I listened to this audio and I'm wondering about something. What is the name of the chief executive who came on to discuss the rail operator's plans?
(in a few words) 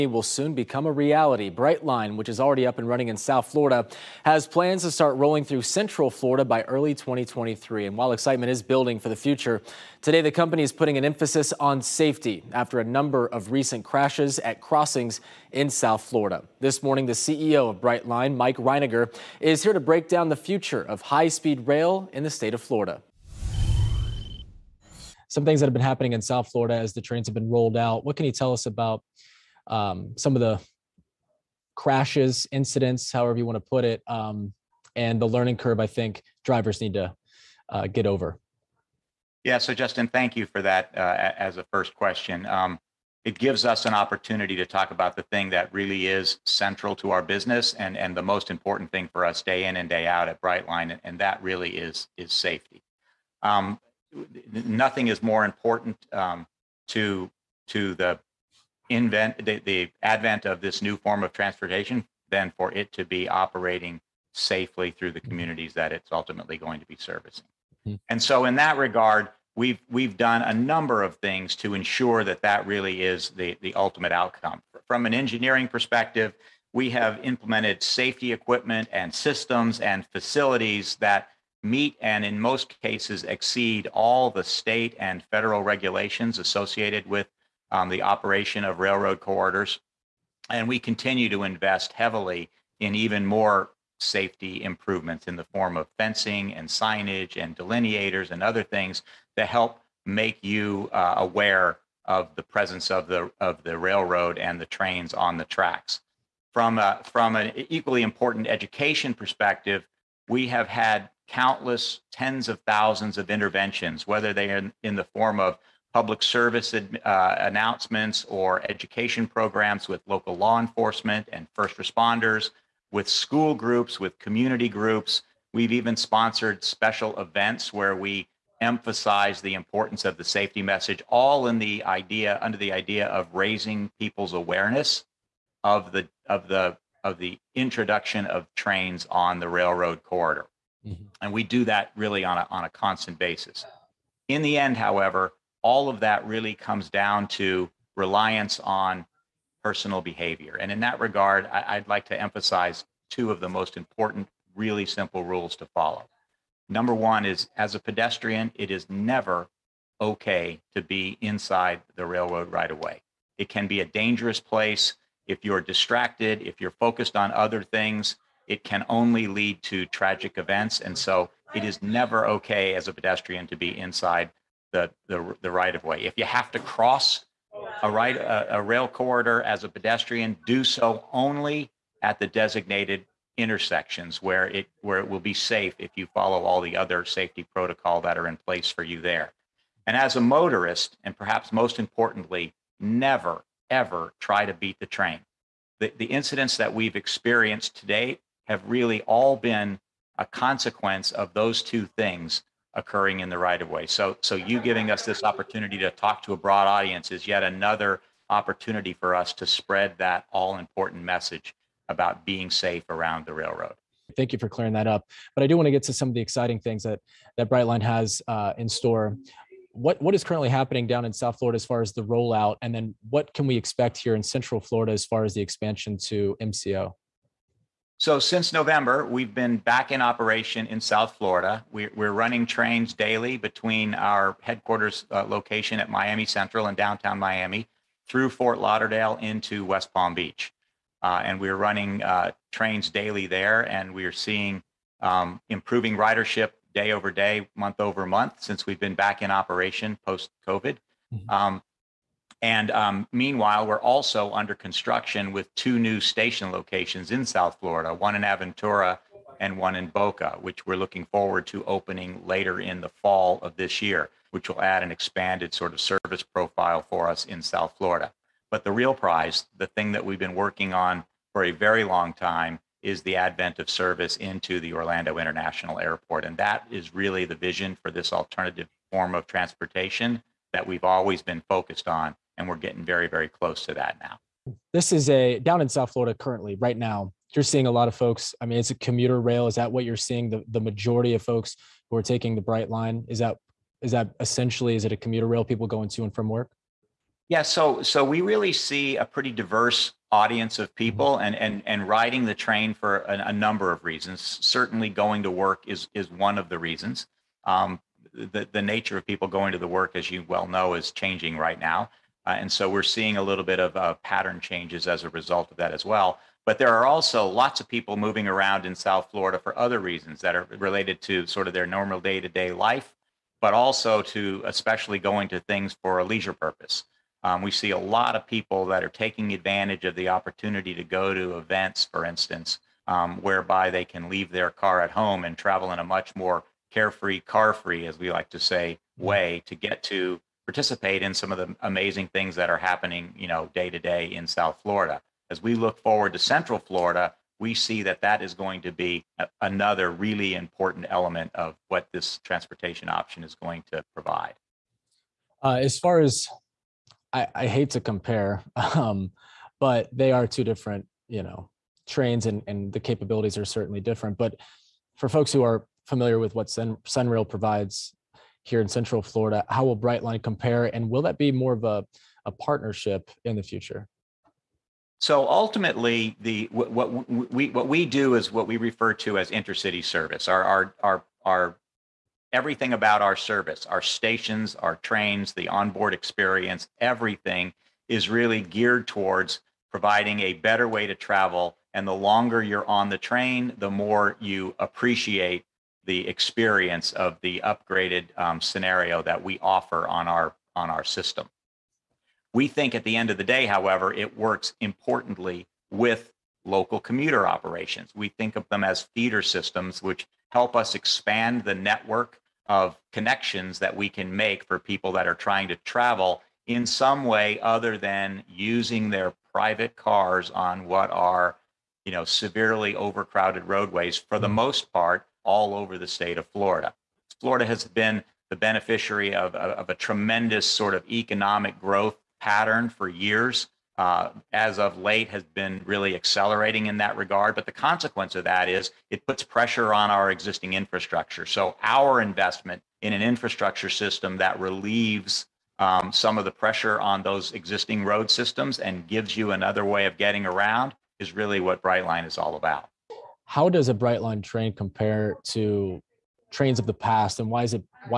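Mike Reininger.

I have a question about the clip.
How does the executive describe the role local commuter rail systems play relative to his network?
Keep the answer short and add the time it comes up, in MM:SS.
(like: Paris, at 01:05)
feeder systems, at 06:48.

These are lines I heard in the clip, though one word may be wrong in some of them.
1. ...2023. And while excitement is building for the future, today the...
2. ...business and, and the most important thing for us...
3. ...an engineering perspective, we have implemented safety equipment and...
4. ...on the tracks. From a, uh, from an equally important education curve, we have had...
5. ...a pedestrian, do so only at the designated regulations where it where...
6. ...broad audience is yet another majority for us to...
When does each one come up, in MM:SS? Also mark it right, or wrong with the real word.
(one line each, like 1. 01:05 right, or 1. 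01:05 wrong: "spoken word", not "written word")
1. 00:06 right
2. 00:47 right
3. 01:15 right
4. 01:45 wrong: "perspective", not "curve"
5. 02:59 wrong: "intersections", not "regulations"
6. 03:26 wrong: "opportunity", not "majority".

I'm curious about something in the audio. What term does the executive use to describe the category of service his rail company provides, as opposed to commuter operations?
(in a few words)
intercity service.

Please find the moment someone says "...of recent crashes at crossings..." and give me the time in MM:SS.
00:13.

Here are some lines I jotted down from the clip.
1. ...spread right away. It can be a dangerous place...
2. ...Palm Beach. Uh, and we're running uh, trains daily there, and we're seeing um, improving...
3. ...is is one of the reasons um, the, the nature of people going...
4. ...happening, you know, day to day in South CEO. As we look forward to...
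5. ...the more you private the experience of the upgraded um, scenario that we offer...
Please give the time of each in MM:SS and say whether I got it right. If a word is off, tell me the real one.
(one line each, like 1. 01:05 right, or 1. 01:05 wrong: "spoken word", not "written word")
1. 02:42 wrong: "railroad", not "spread"
2. 03:59 right
3. 05:05 right
4. 05:42 wrong: "Florida", not "CEO"
5. 06:33 wrong: "appreciate", not "private".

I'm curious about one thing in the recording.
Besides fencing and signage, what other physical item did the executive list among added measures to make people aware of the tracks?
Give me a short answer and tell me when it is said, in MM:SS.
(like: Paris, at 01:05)
delineators, at 01:37.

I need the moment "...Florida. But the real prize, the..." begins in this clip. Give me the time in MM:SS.
04:27.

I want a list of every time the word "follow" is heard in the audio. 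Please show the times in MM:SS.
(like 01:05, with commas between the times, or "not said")
02:35, 03:06.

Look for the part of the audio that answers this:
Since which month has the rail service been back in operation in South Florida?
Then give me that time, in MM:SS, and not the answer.
03:48.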